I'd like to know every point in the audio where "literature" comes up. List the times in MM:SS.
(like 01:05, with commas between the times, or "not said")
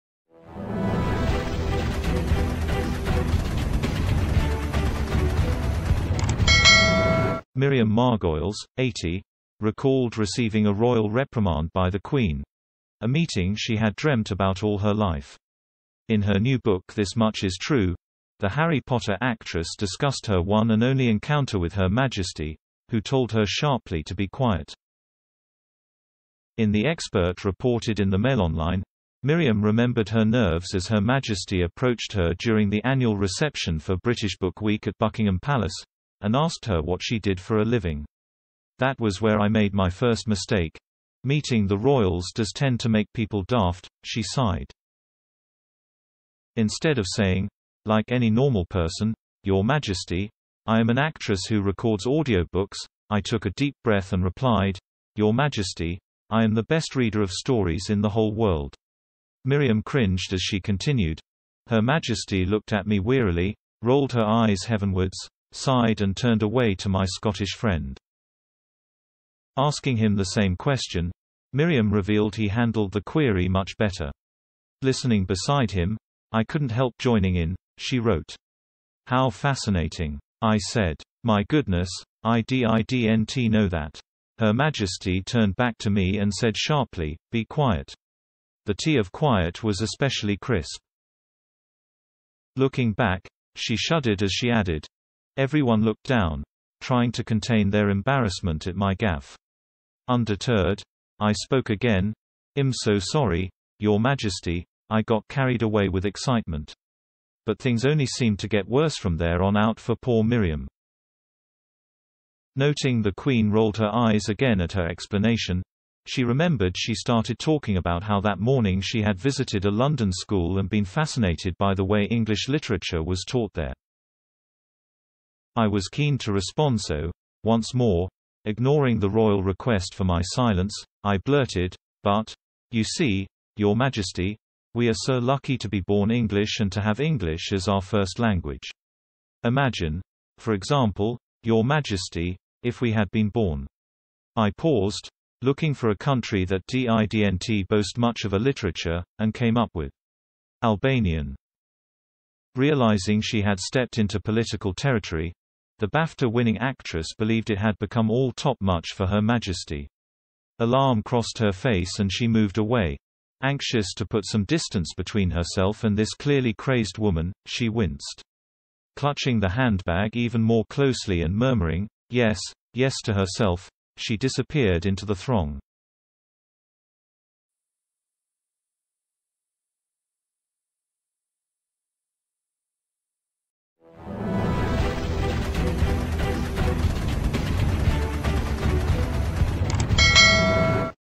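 02:02, 02:28.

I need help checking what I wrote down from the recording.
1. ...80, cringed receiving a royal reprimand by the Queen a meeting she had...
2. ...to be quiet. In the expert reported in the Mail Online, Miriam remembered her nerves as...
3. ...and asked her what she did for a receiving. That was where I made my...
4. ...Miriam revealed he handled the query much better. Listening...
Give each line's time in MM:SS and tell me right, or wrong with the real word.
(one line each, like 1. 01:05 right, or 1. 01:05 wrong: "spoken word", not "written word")
1. 00:08 wrong: "recalled", not "cringed"
2. 00:24 right
3. 00:36 wrong: "living", not "receiving"
4. 01:11 right.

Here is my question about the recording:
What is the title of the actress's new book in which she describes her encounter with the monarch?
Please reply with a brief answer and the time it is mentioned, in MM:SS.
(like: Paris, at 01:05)
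This Much Is True, at 00:16.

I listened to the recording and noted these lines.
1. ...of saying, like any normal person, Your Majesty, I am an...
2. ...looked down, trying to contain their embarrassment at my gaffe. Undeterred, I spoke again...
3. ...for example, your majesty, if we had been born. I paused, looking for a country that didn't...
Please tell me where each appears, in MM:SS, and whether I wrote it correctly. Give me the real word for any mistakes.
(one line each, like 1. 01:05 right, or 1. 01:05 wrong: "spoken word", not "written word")
1. 00:46 right
2. 01:35 right
3. 02:20 right.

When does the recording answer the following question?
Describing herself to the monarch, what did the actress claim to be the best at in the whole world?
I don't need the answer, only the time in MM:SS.
00:56.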